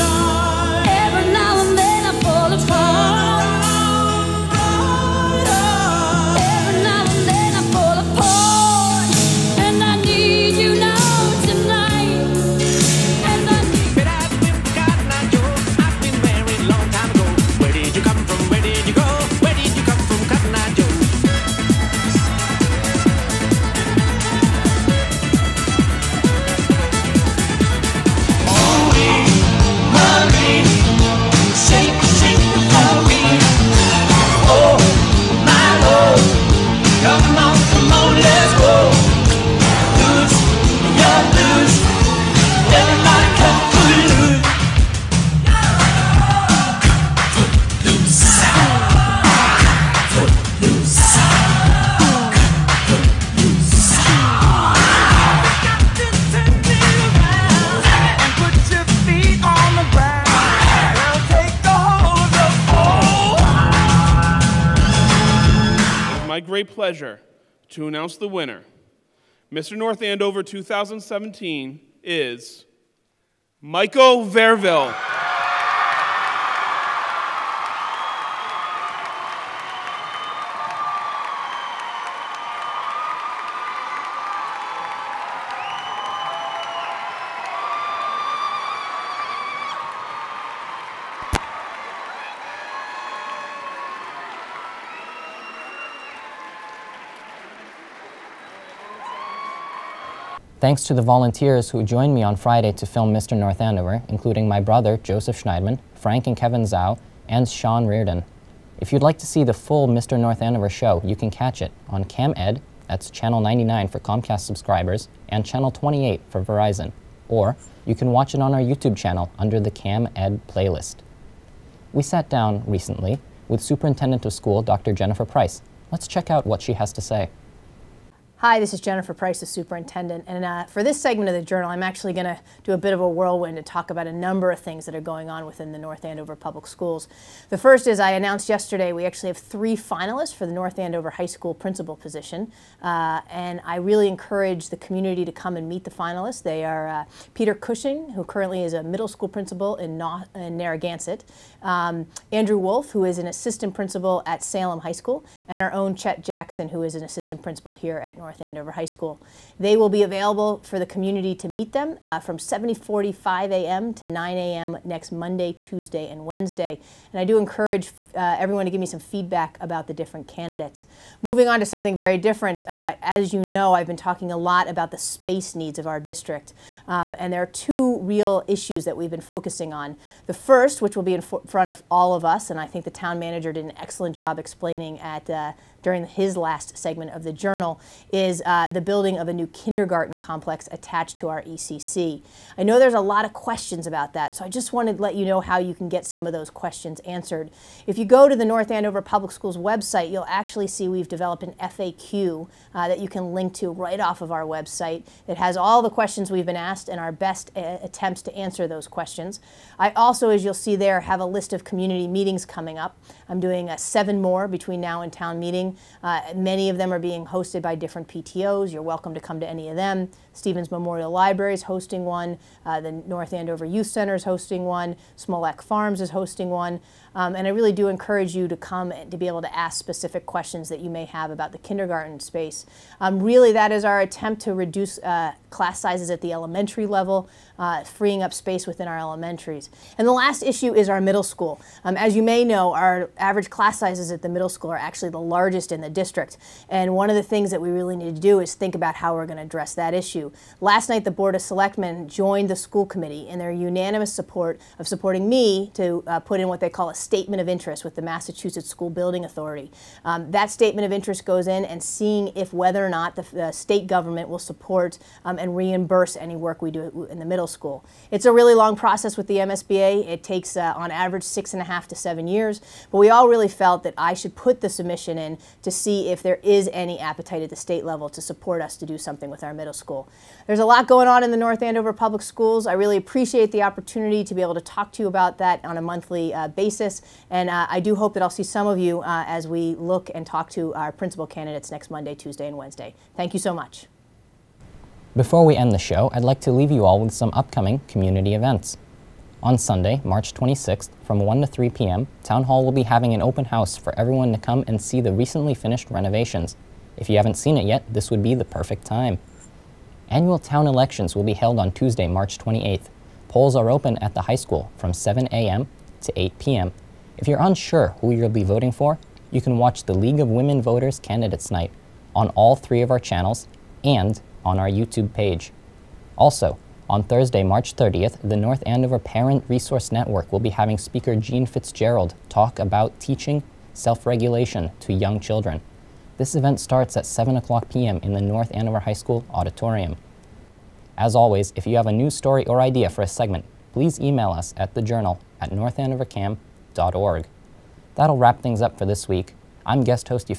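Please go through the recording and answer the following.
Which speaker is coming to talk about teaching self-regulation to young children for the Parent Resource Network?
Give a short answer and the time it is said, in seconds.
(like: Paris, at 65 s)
Jean Fitzgerald, at 331 s.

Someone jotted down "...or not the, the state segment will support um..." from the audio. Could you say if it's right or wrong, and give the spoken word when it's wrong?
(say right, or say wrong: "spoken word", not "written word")
wrong: "government", not "segment".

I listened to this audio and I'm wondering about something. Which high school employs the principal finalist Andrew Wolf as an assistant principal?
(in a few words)
Salem High School.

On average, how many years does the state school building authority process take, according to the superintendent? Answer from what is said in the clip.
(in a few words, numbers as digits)
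6.5 to 7 years.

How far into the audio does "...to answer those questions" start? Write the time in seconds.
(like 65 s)
208 s.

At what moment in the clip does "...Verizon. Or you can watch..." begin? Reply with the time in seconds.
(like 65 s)
116 s.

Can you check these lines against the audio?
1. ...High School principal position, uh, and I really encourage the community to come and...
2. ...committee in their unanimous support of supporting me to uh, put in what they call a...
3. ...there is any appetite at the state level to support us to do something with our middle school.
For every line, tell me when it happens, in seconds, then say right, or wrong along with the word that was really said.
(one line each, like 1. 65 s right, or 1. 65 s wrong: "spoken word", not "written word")
1. 141 s right
2. 252 s right
3. 276 s right.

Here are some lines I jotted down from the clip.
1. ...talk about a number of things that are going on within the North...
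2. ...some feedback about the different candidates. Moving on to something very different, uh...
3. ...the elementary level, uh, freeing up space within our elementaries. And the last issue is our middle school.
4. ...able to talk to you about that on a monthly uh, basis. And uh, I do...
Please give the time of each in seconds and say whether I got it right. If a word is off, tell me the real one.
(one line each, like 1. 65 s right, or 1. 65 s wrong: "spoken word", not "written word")
1. 133 s right
2. 168 s right
3. 236 s right
4. 284 s right.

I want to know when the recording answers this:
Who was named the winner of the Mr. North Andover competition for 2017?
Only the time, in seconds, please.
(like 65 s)
73 s.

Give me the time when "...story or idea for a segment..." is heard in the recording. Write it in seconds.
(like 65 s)
342 s.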